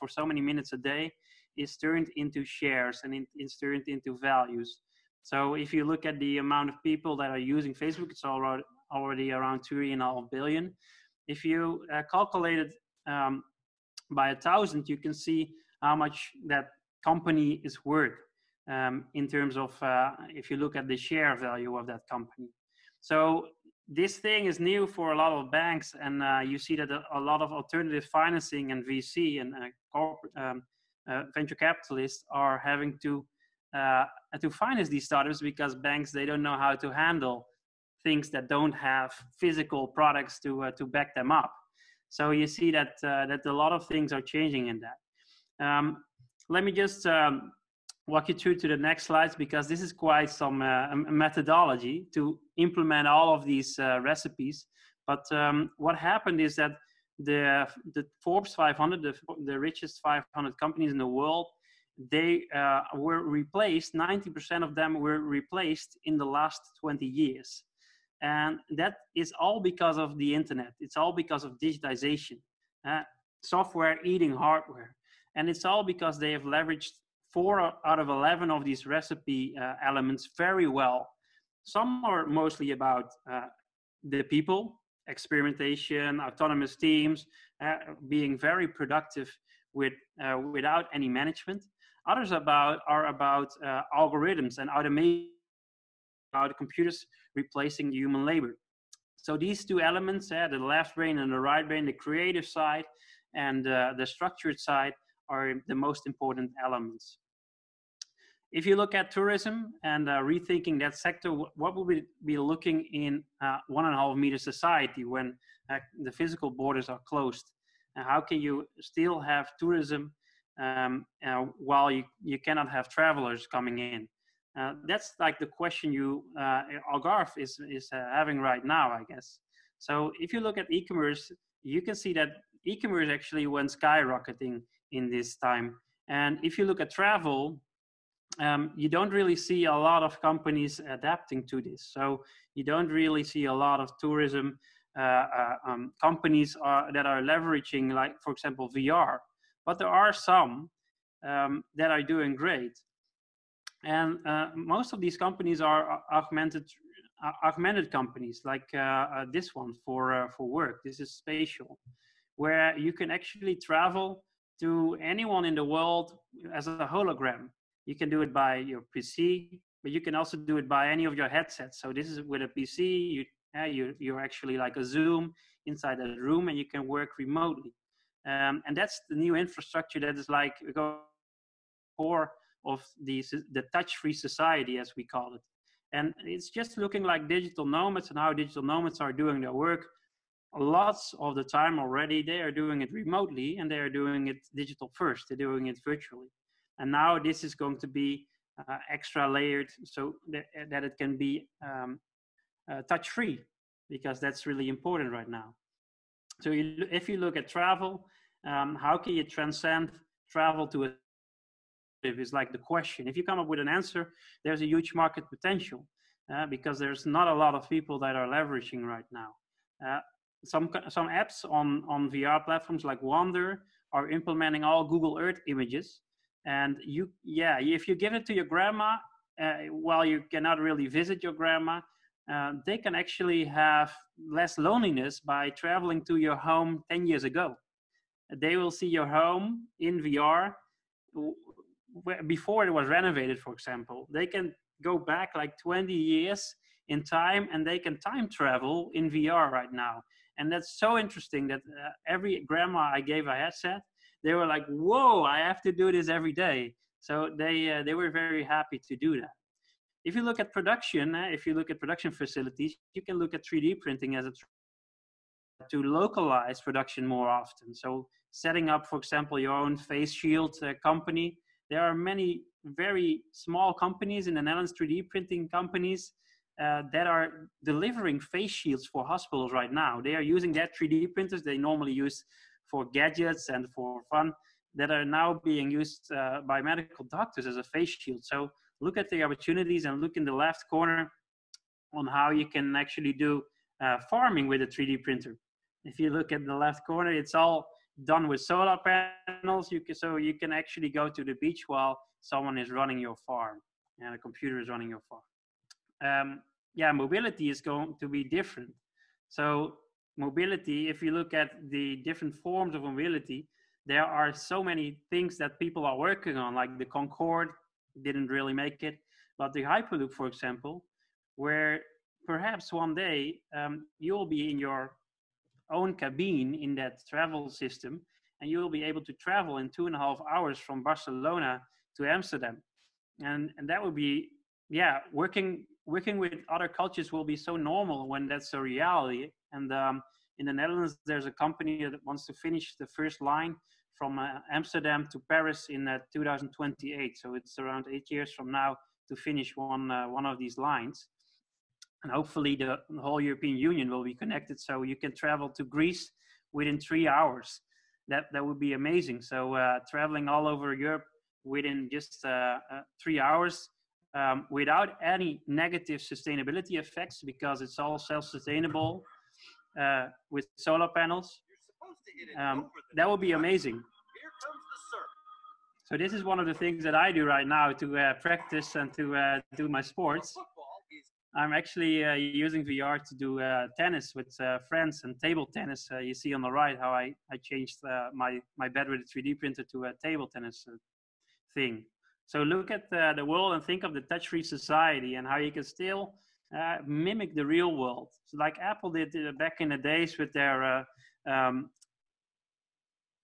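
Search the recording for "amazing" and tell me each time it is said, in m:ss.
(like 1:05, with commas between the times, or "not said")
5:58, 6:13.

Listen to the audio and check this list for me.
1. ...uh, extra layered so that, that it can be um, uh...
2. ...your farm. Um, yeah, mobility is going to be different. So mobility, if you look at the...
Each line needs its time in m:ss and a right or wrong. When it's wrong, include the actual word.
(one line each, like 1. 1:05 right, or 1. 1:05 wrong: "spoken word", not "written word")
1. 3:18 right
2. 5:04 right.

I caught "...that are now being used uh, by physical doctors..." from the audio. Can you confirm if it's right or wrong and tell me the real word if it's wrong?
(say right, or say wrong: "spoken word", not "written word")
wrong: "medical", not "physical".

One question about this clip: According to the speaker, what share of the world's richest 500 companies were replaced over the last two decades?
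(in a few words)
90%.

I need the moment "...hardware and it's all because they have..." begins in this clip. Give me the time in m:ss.
1:14.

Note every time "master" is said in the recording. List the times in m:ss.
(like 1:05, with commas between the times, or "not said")
not said.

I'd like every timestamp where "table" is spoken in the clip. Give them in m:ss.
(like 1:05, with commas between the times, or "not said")
6:25, 6:30.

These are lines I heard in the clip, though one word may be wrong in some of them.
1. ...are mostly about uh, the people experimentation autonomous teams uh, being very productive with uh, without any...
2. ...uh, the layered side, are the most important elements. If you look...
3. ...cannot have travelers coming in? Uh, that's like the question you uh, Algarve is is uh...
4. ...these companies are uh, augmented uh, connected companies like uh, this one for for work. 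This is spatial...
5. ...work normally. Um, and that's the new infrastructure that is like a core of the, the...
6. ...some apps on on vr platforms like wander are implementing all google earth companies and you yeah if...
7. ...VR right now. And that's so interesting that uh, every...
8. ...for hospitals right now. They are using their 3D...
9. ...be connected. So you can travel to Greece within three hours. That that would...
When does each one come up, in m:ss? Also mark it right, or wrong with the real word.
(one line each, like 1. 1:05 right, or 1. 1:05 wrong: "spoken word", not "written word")
1. 1:22 right
2. 1:43 wrong: "structured", not "layered"
3. 2:02 right
4. 2:35 wrong: "augmented", not "connected"
5. 2:56 wrong: "remotely", not "normally"
6. 3:40 wrong: "images", not "companies"
7. 4:09 right
8. 4:38 right
9. 5:54 right.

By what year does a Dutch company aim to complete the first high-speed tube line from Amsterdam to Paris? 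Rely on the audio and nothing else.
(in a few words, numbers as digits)
2028.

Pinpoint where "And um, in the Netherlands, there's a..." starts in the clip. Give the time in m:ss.
5:39.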